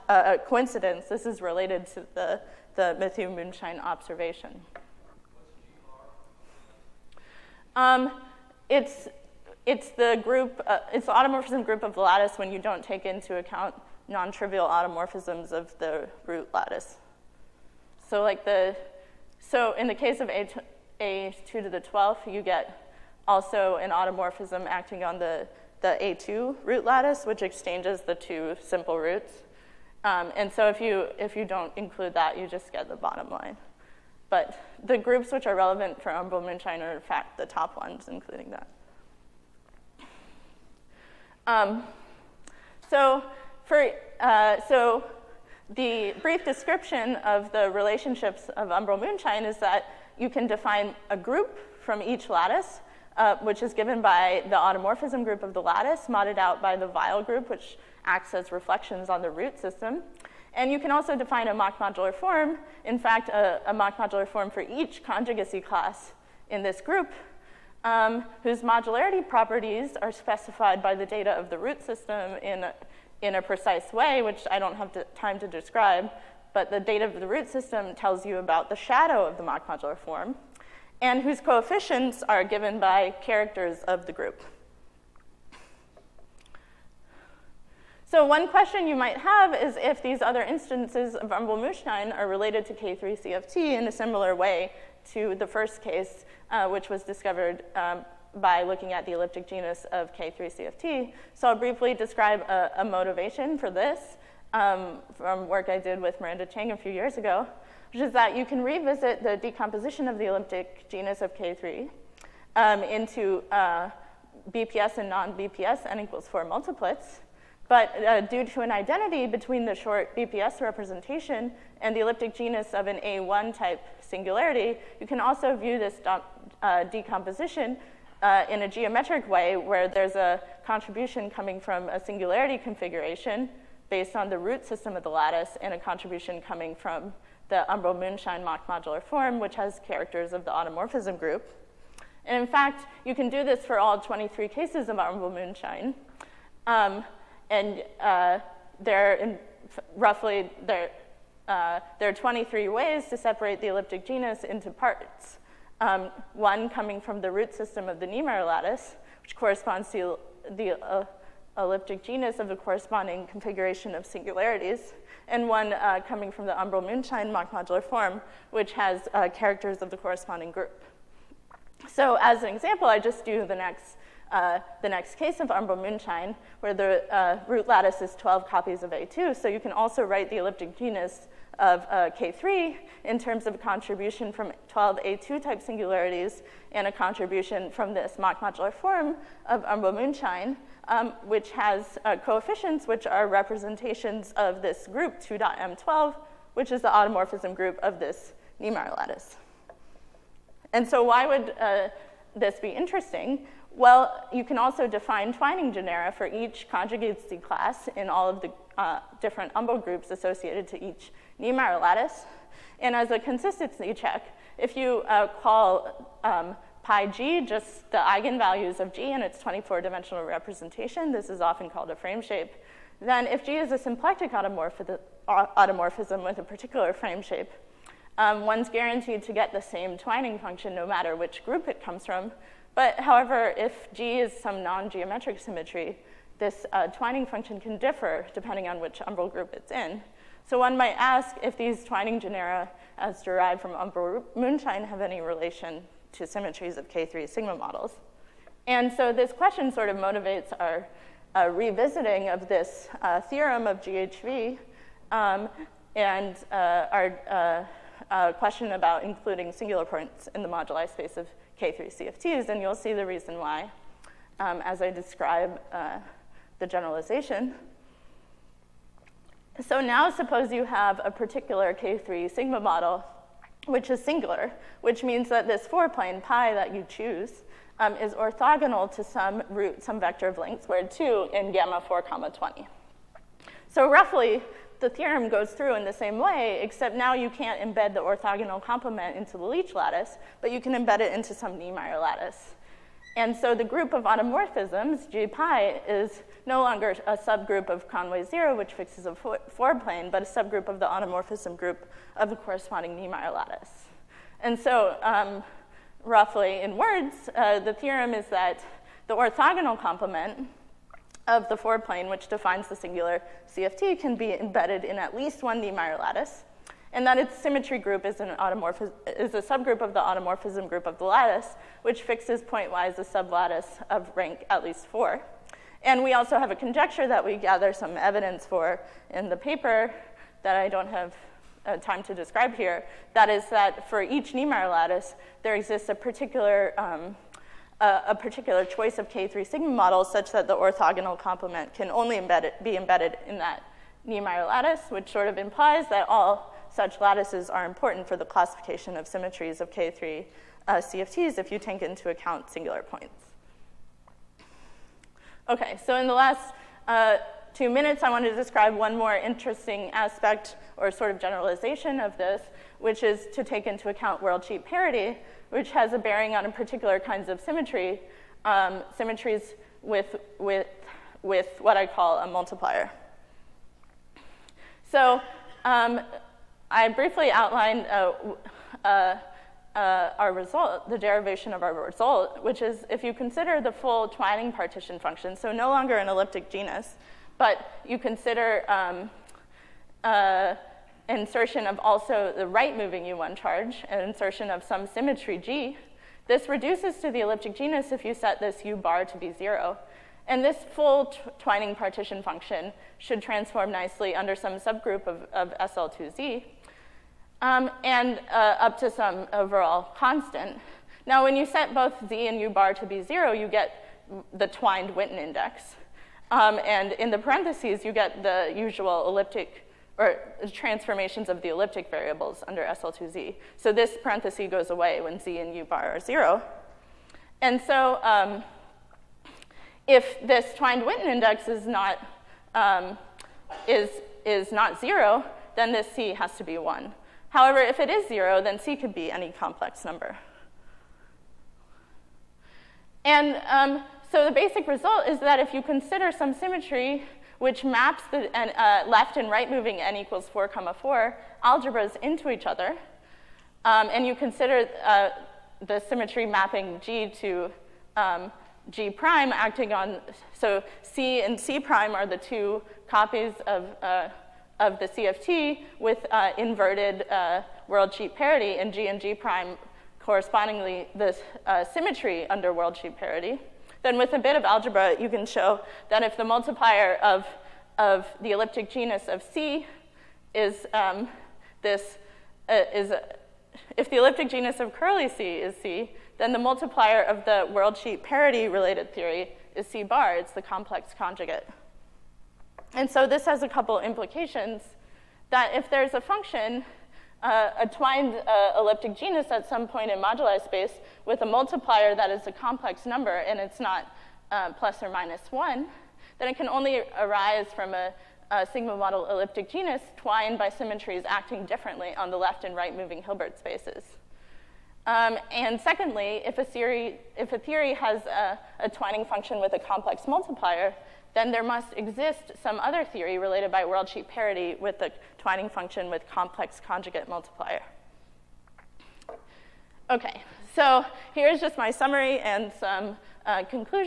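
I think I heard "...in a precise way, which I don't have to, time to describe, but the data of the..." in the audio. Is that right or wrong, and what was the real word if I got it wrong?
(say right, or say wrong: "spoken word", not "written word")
right.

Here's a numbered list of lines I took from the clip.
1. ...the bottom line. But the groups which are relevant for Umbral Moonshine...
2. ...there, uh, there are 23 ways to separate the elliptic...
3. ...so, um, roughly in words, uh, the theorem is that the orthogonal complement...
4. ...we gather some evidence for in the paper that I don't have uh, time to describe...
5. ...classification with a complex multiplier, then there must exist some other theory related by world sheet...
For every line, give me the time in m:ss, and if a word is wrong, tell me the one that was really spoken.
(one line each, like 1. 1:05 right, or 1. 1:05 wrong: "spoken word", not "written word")
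1. 0:32 right
2. 2:30 right
3. 5:04 right
4. 5:27 right
5. 8:39 wrong: "function", not "classification".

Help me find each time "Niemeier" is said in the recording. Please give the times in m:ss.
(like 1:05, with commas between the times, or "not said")
2:38, 3:18, 3:31, 4:51, 5:02, 5:15, 5:34, 5:44.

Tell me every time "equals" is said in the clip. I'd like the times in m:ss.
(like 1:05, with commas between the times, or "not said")
1:55, 7:29.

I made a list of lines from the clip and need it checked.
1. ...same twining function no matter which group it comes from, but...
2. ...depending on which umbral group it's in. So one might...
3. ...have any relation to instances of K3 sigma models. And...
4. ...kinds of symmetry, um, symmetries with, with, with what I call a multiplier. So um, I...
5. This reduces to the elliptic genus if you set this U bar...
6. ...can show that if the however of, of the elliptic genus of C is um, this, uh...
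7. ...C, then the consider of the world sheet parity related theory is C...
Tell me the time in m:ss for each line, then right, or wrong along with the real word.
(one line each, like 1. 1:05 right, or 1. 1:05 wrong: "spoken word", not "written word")
1. 3:49 right
2. 3:58 right
3. 4:04 wrong: "symmetries", not "instances"
4. 6:07 right
5. 6:36 right
6. 7:55 wrong: "multiplier", not "however"
7. 8:05 wrong: "multiplier", not "consider".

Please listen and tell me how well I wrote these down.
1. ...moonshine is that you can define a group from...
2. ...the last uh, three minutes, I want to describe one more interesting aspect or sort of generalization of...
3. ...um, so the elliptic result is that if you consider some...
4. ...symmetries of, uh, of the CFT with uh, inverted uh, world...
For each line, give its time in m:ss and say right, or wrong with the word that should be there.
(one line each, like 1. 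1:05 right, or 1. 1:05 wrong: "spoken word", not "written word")
1. 0:49 right
2. 5:56 wrong: "two", not "three"
3. 7:23 wrong: "basic", not "elliptic"
4. 7:42 wrong: "copies", not "symmetries".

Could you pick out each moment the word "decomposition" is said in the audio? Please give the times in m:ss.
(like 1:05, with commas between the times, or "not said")
1:49, 2:06.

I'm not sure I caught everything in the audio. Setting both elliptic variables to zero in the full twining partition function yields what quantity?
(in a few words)
twined Witten index.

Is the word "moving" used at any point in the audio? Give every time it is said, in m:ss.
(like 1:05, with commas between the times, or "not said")
6:32, 7:29, 8:32.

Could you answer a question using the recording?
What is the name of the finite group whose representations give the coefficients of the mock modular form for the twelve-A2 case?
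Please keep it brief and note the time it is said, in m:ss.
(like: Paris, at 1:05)
2.M12, at 3:15.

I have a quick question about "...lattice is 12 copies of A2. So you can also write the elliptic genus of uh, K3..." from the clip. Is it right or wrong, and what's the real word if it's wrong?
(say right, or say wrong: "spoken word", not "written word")
right.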